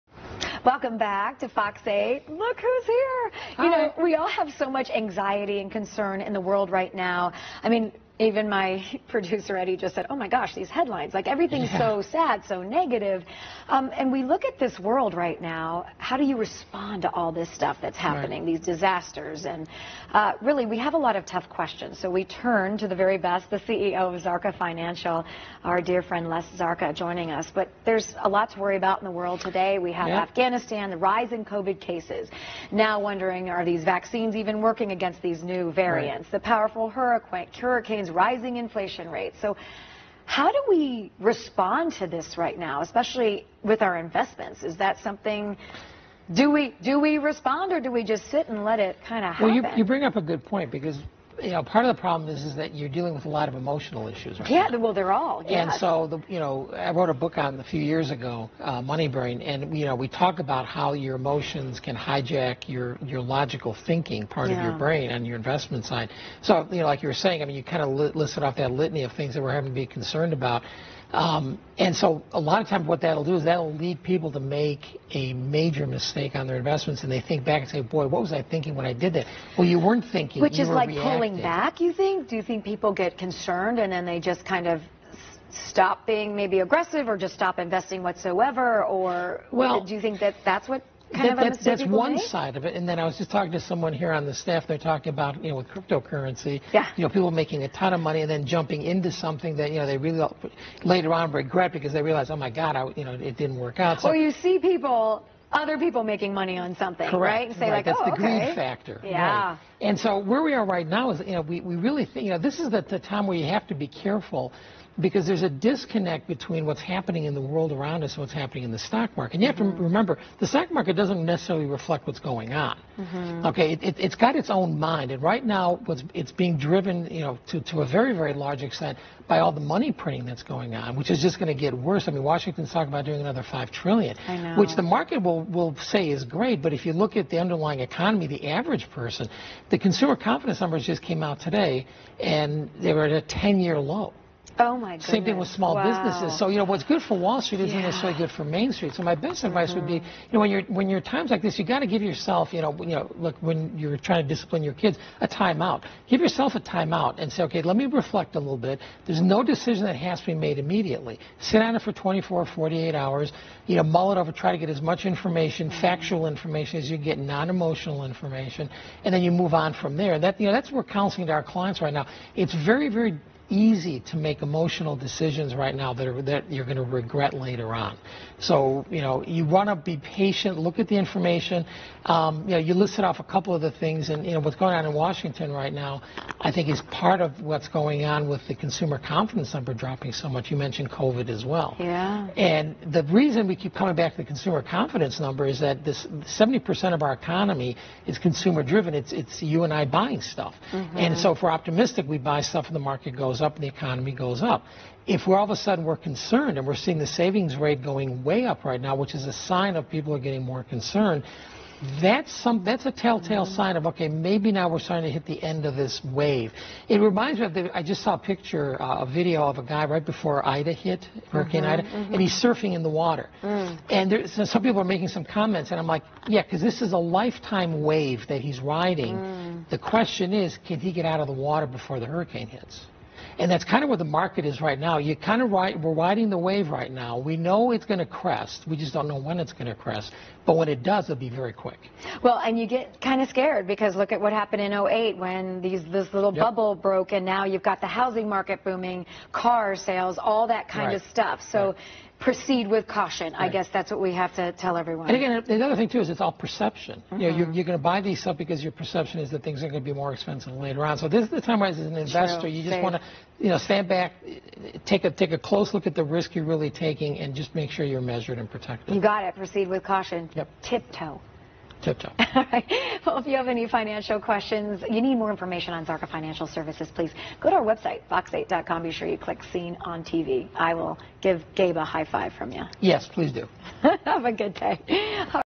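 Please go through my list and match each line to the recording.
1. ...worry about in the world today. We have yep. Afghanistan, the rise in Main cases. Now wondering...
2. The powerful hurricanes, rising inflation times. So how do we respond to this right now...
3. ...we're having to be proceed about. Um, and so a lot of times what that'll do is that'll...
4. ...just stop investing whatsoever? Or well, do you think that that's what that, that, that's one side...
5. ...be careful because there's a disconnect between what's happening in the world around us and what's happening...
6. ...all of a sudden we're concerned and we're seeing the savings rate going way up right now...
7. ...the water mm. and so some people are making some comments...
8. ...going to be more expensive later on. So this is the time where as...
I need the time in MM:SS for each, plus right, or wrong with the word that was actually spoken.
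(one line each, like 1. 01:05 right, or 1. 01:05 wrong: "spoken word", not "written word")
1. 00:28 wrong: "COVID", not "Main"
2. 00:36 wrong: "rates", not "times"
3. 01:09 wrong: "concerned", not "proceed"
4. 01:27 right
5. 01:53 right
6. 03:25 right
7. 03:42 right
8. 04:19 right.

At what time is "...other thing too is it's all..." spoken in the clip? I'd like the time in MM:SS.
04:15.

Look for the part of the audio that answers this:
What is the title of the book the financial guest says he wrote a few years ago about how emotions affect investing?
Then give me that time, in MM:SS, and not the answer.
00:58.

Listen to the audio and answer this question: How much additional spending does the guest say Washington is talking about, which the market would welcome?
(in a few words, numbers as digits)
5 trillion.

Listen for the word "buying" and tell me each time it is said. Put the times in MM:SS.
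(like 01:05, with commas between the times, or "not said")
03:19.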